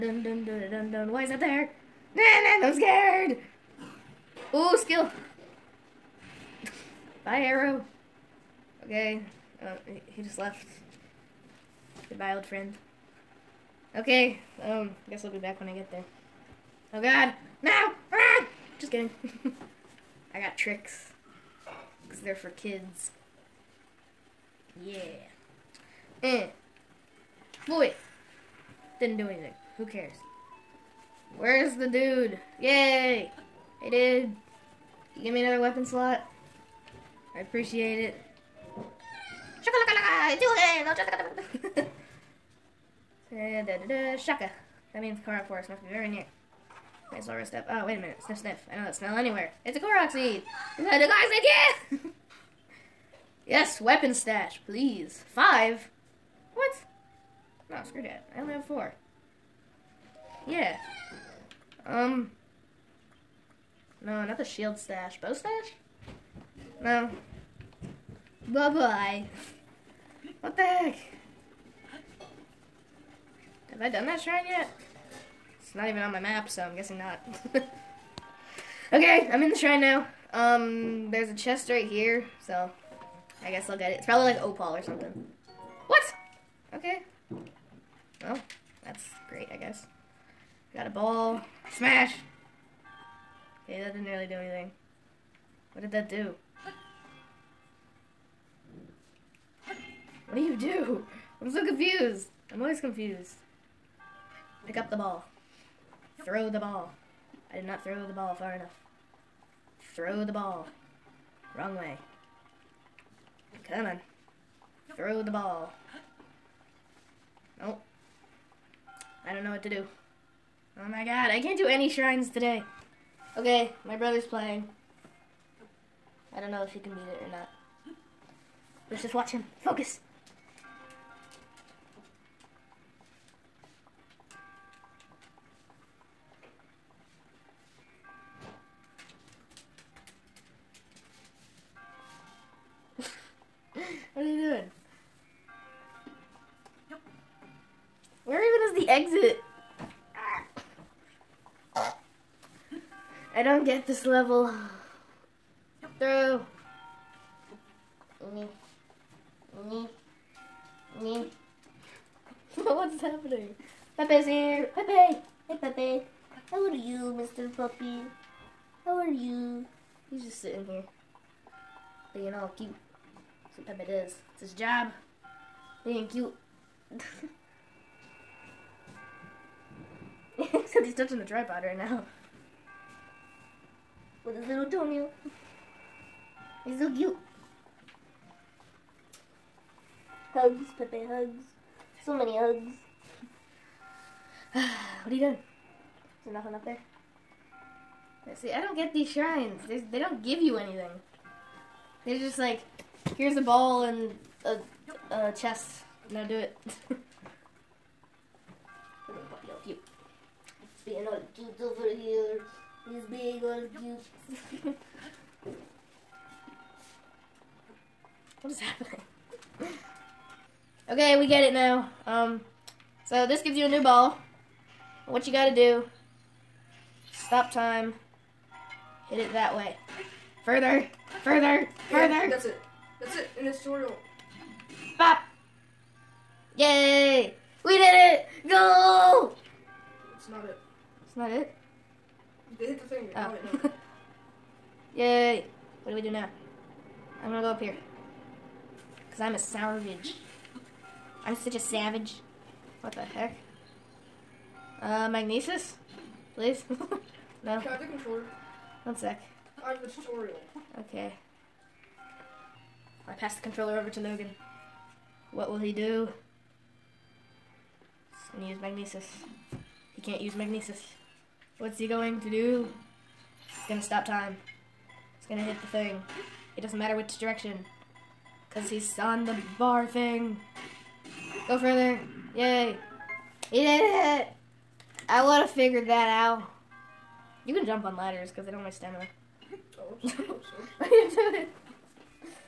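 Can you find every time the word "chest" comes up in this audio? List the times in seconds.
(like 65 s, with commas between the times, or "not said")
81 s, 205 s.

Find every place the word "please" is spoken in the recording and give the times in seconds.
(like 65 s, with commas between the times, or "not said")
54 s, 256 s.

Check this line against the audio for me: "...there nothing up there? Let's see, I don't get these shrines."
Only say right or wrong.
right.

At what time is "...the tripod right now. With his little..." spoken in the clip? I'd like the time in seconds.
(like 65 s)
181 s.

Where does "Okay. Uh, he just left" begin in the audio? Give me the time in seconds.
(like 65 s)
8 s.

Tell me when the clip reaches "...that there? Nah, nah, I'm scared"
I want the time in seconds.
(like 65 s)
1 s.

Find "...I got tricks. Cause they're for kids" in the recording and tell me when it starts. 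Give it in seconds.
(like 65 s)
20 s.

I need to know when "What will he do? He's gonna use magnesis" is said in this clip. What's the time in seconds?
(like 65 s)
265 s.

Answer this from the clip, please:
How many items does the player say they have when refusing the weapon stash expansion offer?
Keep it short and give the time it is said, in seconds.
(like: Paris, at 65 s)
4, at 58 s.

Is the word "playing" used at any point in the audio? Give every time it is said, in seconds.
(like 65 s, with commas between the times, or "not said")
124 s.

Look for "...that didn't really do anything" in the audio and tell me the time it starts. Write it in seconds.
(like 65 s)
93 s.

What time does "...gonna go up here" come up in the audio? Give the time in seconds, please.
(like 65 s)
247 s.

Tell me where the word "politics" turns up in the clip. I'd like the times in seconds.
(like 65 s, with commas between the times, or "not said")
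not said.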